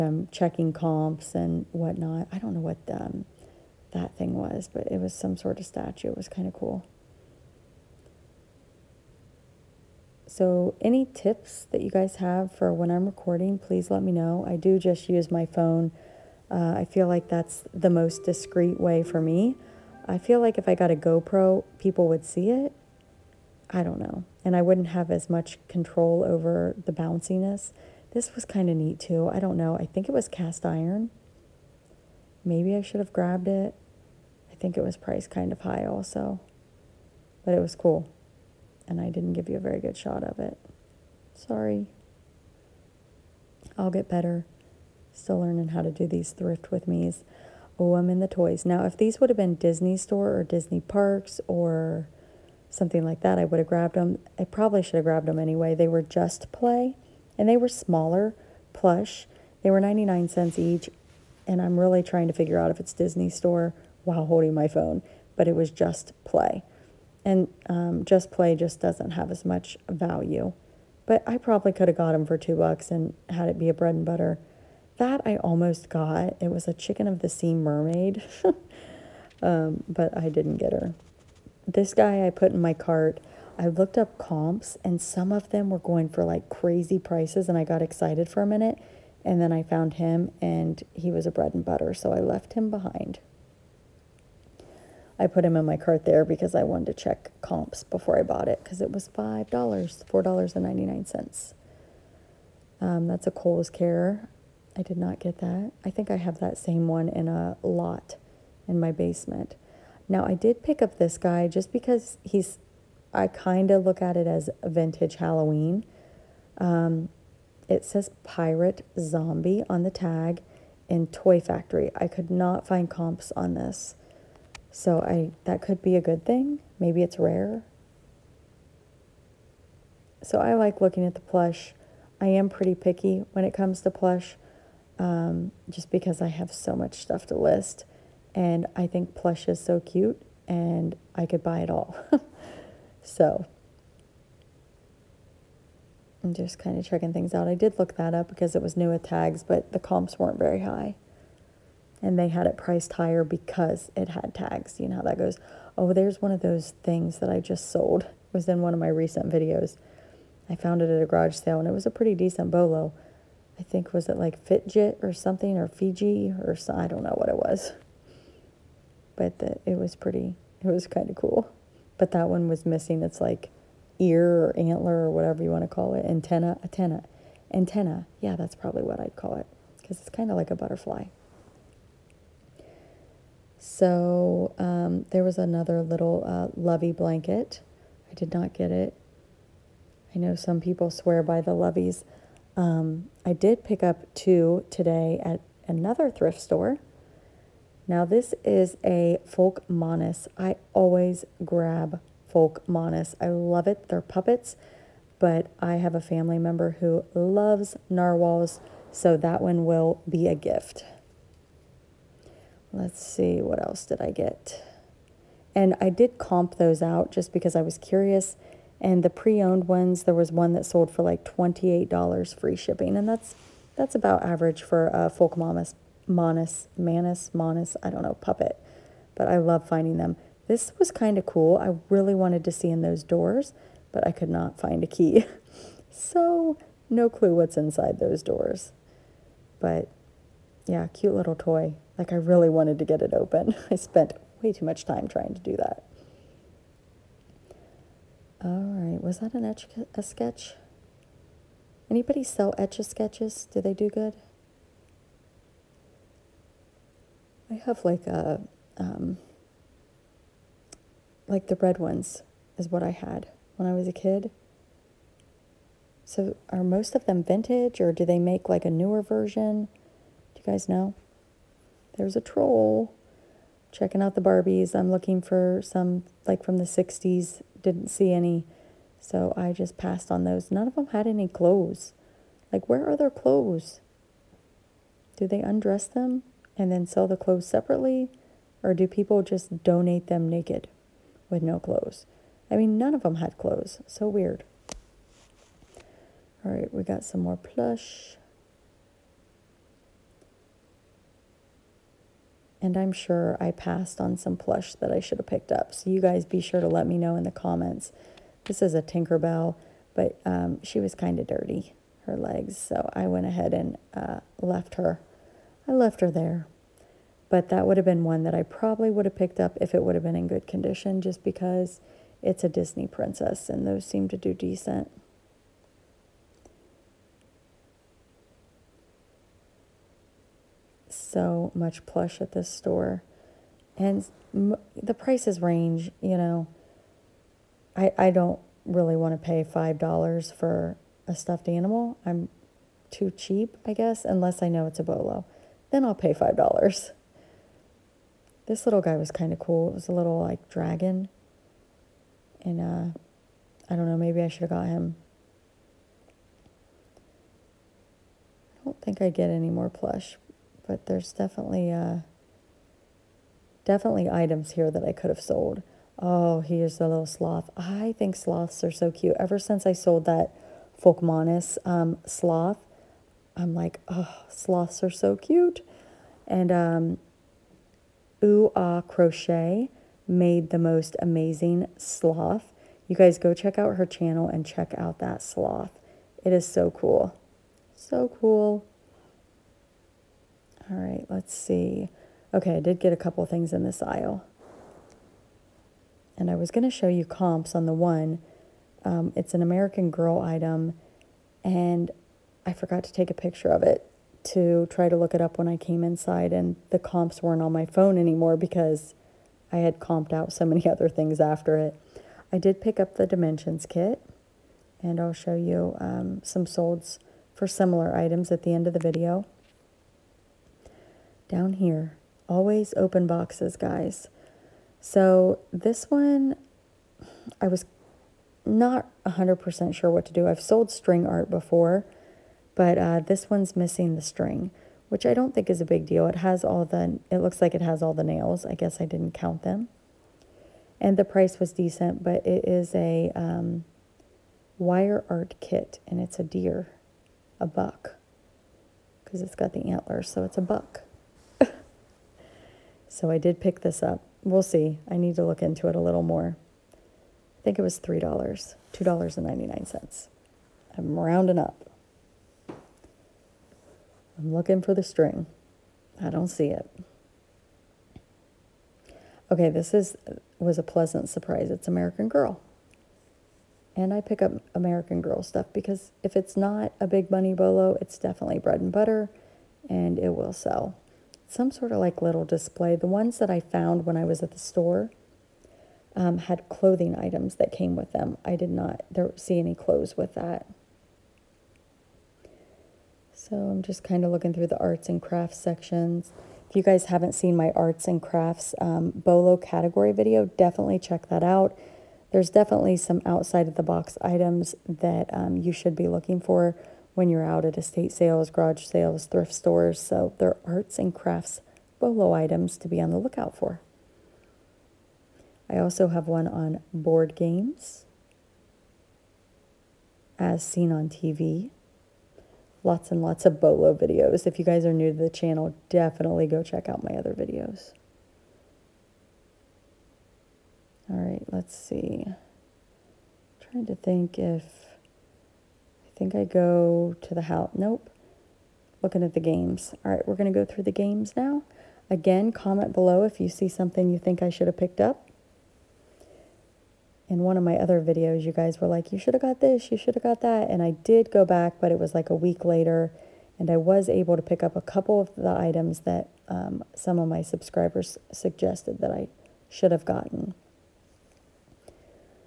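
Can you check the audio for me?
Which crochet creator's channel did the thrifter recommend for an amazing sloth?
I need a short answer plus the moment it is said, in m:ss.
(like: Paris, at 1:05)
Ooh Ah Crochet, at 6:18.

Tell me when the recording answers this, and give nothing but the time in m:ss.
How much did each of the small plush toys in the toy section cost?
0:59.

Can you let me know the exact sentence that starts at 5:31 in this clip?
so much plush at this store.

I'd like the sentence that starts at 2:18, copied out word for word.
And I think plush is so cute and I could buy it all.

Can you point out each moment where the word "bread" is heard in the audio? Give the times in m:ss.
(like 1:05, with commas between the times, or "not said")
1:13, 1:31, 7:58.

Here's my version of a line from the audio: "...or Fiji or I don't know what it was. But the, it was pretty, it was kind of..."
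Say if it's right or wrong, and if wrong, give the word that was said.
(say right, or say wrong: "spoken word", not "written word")
right.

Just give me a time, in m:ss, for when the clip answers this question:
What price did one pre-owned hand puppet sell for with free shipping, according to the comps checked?
3:41.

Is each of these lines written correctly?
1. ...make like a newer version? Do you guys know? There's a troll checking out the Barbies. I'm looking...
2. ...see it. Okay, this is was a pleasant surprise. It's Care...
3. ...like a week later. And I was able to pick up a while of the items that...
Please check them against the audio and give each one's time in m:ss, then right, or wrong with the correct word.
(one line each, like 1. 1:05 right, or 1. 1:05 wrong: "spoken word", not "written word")
1. 4:28 right
2. 7:46 wrong: "American", not "Care"
3. 9:11 wrong: "couple", not "while".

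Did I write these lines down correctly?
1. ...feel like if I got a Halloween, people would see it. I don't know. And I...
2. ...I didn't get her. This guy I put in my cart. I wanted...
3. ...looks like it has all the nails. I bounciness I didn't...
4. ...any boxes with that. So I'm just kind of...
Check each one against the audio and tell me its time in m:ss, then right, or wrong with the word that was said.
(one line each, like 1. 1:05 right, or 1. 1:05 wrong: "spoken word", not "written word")
1. 0:20 wrong: "GoPro", not "Halloween"
2. 1:20 wrong: "looked", not "wanted"
3. 7:17 wrong: "guess", not "bounciness"
4. 8:09 wrong: "clothes", not "boxes".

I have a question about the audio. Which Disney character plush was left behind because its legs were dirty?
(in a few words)
Tinkerbell.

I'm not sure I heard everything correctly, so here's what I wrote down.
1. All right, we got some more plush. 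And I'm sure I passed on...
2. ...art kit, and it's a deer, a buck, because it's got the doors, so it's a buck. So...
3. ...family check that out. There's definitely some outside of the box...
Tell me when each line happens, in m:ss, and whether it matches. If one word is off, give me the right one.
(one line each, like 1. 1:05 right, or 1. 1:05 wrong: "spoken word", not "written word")
1. 4:56 right
2. 7:25 wrong: "antlers", not "doors"
3. 8:20 wrong: "definitely", not "family".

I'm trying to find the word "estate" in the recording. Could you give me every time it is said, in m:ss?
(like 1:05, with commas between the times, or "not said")
8:27.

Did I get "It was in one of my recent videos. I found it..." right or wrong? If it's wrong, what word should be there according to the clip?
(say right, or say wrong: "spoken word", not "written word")
right.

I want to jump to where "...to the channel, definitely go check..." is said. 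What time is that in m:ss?
8:44.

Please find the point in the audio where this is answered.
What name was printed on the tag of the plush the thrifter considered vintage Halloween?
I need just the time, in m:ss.
1:58.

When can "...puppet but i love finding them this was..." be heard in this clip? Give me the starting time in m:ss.
3:48.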